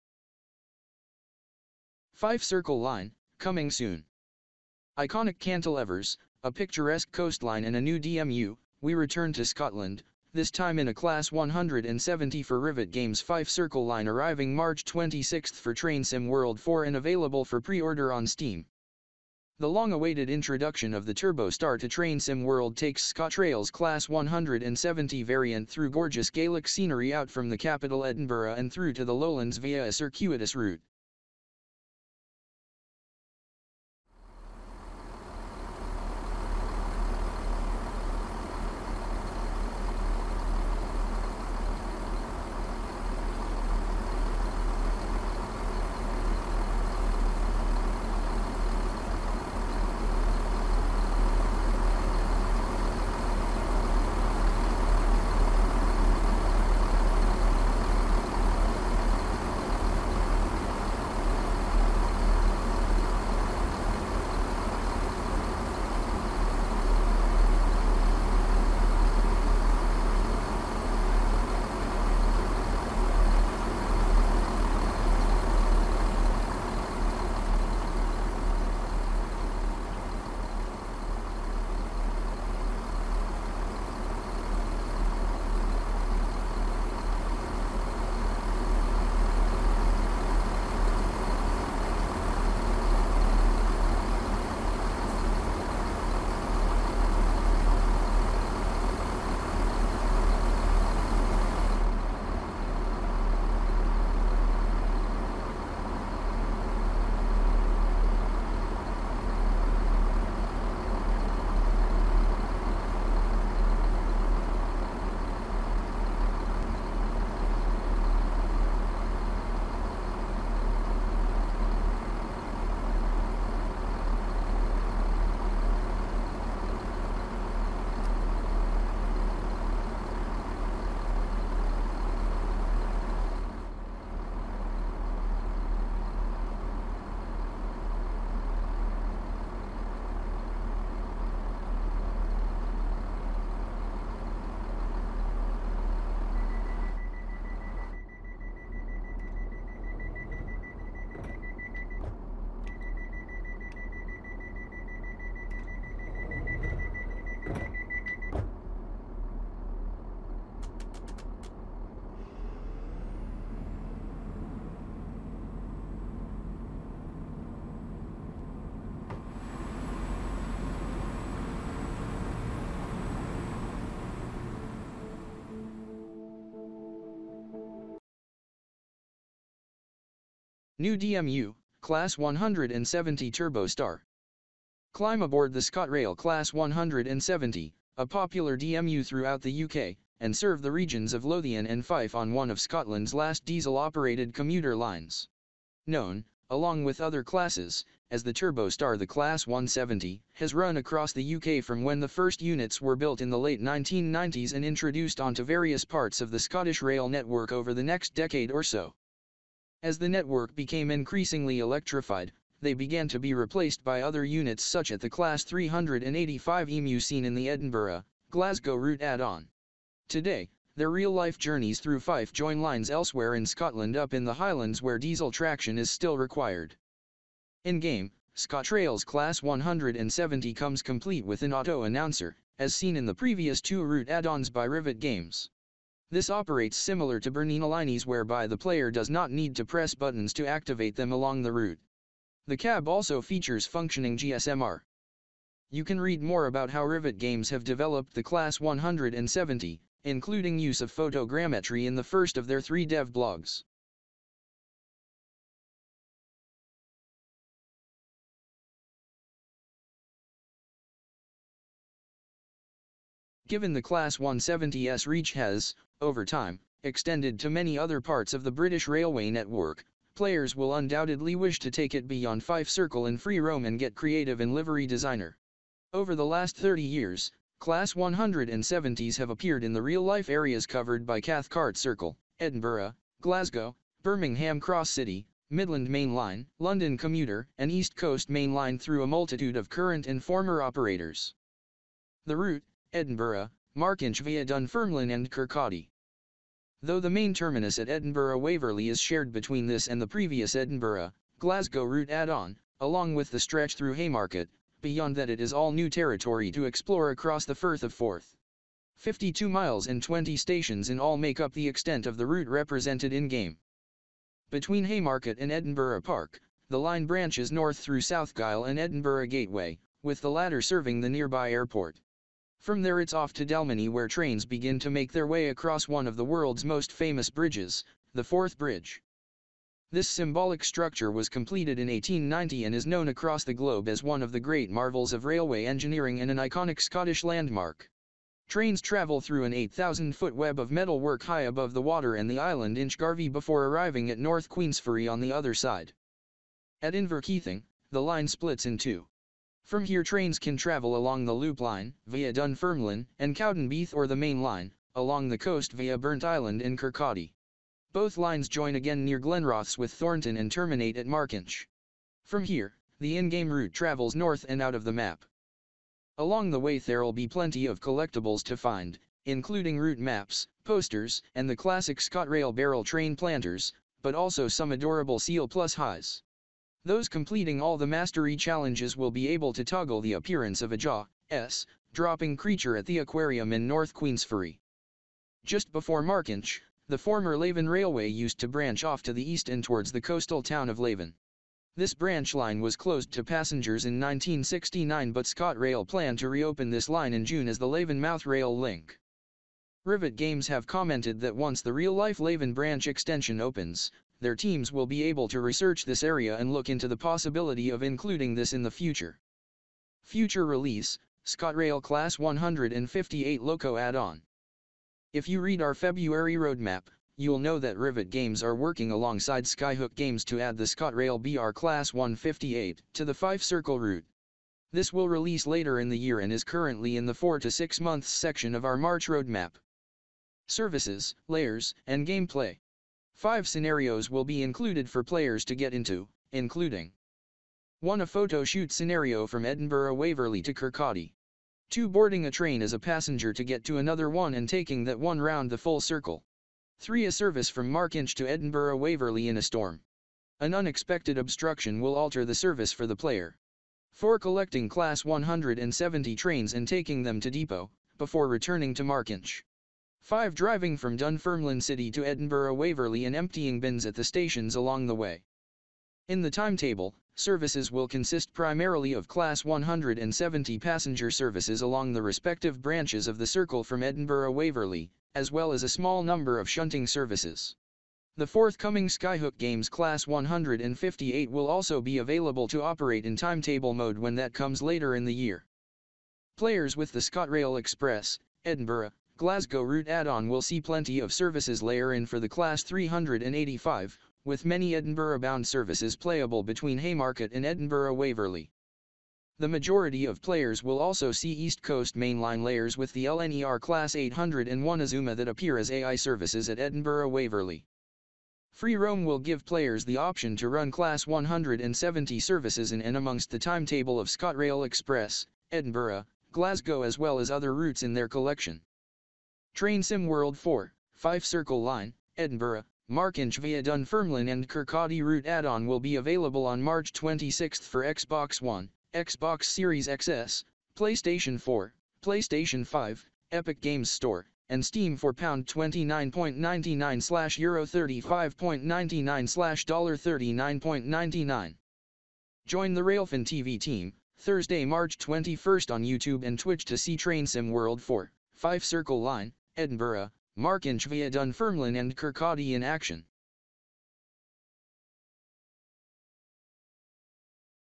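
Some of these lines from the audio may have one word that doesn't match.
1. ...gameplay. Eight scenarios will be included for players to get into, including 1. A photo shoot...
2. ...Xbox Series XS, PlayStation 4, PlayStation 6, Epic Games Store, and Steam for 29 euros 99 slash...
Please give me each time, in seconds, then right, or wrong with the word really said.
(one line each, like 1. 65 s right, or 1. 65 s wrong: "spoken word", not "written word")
1. 432 s wrong: "Five", not "Eight"
2. 528 s wrong: "5", not "6".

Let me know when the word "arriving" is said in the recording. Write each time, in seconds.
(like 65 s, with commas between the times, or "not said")
14 s, 343 s.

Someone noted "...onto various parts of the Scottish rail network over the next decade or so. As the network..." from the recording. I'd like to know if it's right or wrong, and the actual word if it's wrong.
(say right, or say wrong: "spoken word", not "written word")
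right.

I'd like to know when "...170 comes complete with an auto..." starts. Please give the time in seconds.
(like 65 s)
229 s.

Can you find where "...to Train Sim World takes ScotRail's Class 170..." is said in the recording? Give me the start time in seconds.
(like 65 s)
21 s.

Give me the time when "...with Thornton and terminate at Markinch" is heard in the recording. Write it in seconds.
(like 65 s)
359 s.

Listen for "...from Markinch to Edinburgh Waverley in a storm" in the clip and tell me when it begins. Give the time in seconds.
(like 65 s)
447 s.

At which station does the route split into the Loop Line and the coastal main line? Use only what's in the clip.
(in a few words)
Inverkeithing.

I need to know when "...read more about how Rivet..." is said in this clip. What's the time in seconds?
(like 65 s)
246 s.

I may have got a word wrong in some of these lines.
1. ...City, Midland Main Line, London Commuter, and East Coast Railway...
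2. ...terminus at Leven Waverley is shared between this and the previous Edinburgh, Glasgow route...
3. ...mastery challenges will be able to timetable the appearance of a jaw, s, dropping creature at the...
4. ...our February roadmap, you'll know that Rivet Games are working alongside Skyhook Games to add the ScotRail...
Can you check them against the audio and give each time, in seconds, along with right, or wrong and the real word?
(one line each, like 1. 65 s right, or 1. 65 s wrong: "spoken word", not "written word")
1. 284 s wrong: "Main", not "Railway"
2. 297 s wrong: "Edinburgh", not "Leven"
3. 377 s wrong: "toggle", not "timetable"
4. 415 s right.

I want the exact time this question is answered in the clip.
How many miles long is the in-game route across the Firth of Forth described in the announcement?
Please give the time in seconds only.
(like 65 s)
308 s.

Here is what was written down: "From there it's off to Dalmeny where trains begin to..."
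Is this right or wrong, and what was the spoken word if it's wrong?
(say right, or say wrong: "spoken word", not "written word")
right.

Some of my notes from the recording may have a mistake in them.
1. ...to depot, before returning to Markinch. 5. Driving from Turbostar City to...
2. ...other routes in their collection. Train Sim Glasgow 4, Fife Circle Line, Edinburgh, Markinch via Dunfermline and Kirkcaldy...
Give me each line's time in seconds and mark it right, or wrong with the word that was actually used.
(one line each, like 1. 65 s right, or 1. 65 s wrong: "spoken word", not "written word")
1. 457 s wrong: "Dunfermline", not "Turbostar"
2. 517 s wrong: "World", not "Glasgow".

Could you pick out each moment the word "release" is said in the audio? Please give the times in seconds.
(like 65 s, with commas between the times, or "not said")
410 s, 425 s.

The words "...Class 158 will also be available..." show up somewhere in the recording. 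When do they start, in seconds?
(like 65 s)
479 s.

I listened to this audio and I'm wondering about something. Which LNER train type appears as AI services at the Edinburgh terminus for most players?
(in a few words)
Class 801 Azuma.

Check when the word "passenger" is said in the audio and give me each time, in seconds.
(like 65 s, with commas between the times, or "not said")
393 s, 442 s, 470 s.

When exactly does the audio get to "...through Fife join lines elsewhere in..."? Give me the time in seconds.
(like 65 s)
221 s.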